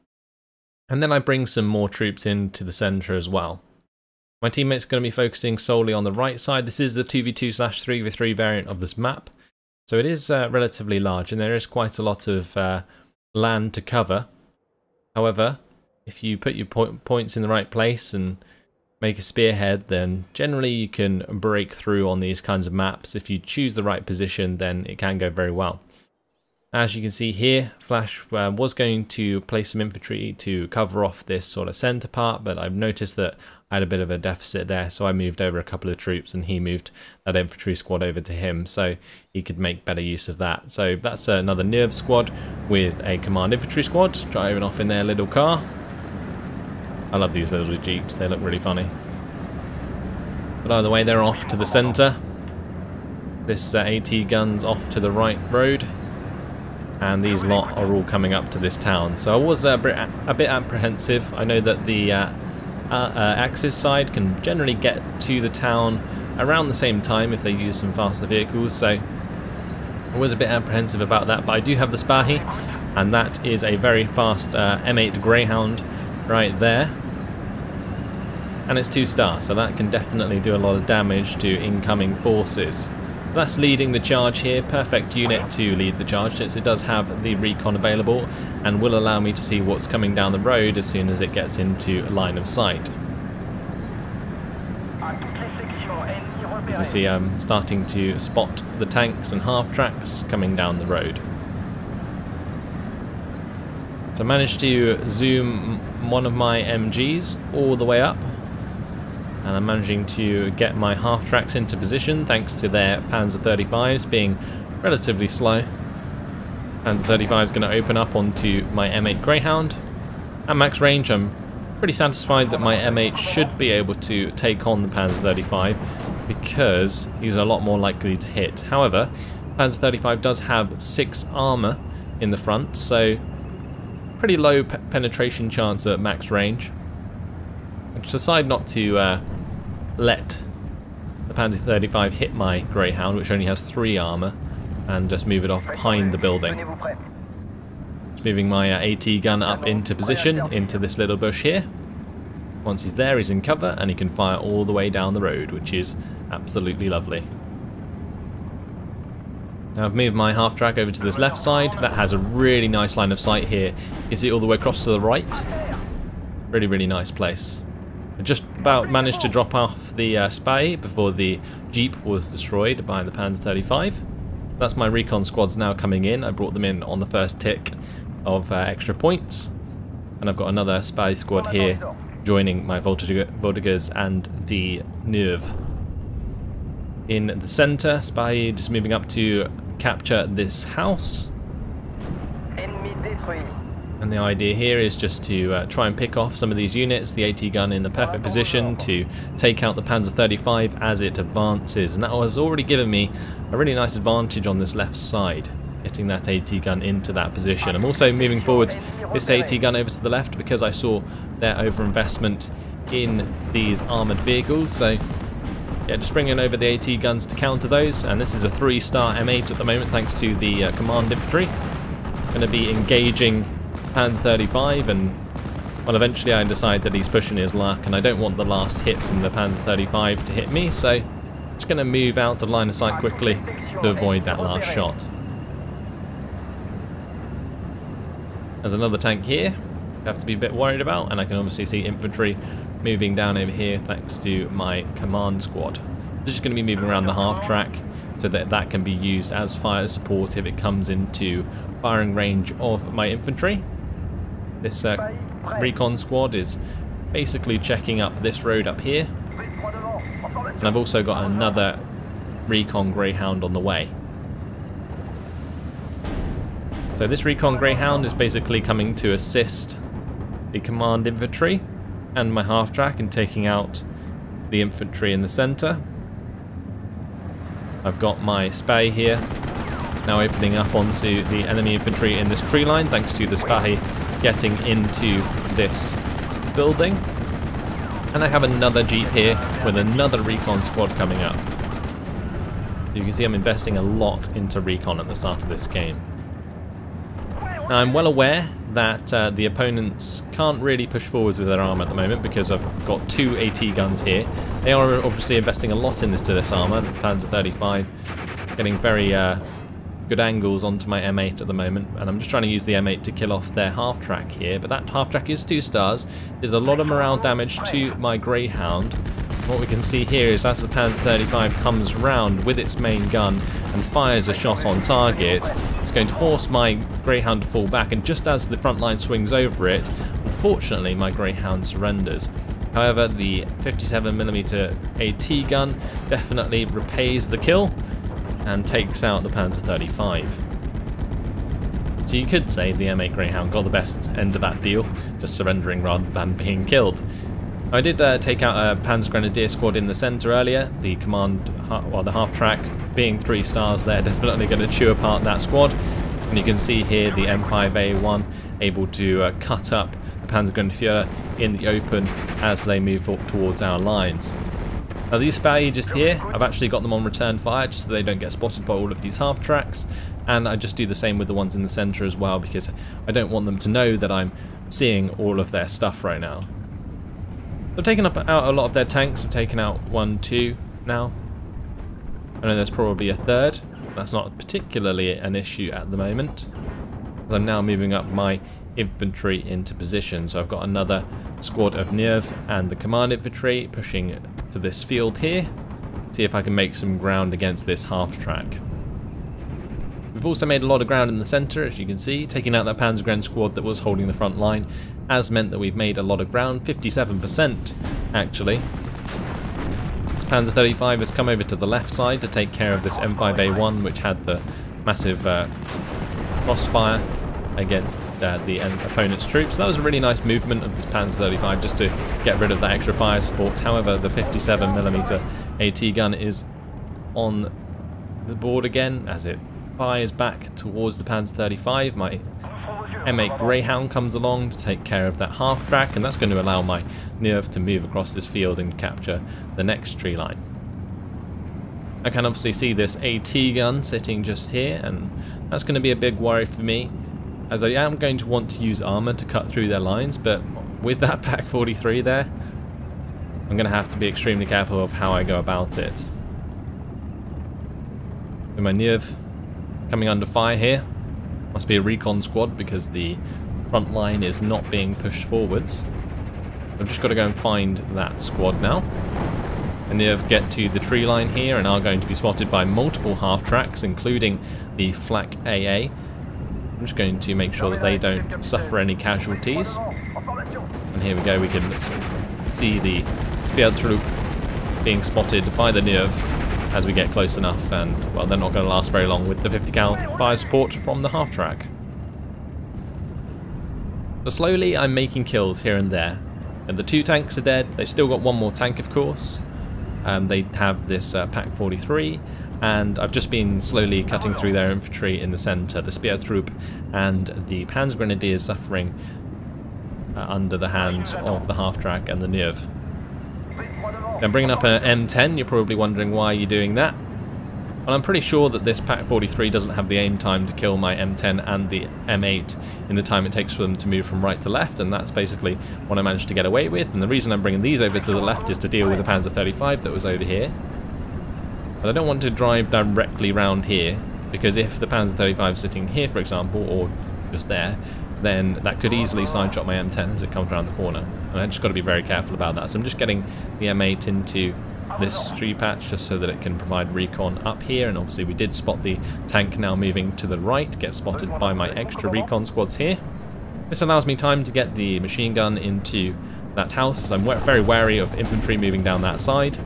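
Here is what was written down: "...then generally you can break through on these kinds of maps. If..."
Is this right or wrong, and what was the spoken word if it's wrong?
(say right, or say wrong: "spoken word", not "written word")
right.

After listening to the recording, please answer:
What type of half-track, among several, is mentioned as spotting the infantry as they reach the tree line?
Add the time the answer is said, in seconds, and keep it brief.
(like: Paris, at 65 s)
Flak AA, at 474 s.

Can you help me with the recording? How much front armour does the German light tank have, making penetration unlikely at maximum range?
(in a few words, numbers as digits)
6.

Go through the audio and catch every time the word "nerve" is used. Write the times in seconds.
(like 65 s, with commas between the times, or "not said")
41 s, 185 s, 391 s, 437 s, 485 s, 512 s.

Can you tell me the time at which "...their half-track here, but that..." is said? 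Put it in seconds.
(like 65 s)
313 s.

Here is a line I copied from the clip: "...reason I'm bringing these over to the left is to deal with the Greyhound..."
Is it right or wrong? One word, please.
wrong.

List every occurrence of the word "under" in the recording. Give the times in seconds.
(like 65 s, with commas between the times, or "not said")
460 s, 510 s.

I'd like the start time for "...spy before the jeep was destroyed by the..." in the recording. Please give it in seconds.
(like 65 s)
170 s.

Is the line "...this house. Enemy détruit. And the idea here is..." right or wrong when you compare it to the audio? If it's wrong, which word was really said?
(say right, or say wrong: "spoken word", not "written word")
right.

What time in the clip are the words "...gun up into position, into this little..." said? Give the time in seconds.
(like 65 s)
149 s.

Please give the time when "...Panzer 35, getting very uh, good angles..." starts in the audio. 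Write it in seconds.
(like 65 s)
306 s.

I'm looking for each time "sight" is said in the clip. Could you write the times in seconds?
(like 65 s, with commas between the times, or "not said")
92 s, 163 s, 232 s.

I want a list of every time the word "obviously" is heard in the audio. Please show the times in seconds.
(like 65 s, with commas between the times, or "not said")
241 s, 305 s, 442 s, 547 s.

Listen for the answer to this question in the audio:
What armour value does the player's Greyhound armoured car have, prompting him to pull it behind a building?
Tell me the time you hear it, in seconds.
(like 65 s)
143 s.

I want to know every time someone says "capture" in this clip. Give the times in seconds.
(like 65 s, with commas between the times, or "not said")
189 s, 438 s.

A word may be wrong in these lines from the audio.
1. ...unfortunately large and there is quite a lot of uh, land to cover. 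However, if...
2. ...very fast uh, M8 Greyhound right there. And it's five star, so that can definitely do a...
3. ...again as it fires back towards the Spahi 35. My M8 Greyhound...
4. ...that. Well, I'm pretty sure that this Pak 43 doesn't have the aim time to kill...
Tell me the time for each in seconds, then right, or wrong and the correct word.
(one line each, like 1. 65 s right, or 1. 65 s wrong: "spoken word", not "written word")
1. 10 s wrong: "relatively", not "unfortunately"
2. 73 s wrong: "two", not "five"
3. 428 s wrong: "Panzer", not "Spahi"
4. 516 s right.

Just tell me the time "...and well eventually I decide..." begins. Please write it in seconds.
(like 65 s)
224 s.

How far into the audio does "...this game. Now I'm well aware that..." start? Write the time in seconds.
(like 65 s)
295 s.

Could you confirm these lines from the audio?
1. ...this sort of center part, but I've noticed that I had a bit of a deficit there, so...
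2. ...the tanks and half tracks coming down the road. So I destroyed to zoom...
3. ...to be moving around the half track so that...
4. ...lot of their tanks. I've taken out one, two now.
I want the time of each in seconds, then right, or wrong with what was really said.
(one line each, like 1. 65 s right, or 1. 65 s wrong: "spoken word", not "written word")
1. 31 s right
2. 98 s wrong: "managed", not "destroyed"
3. 246 s right
4. 378 s right.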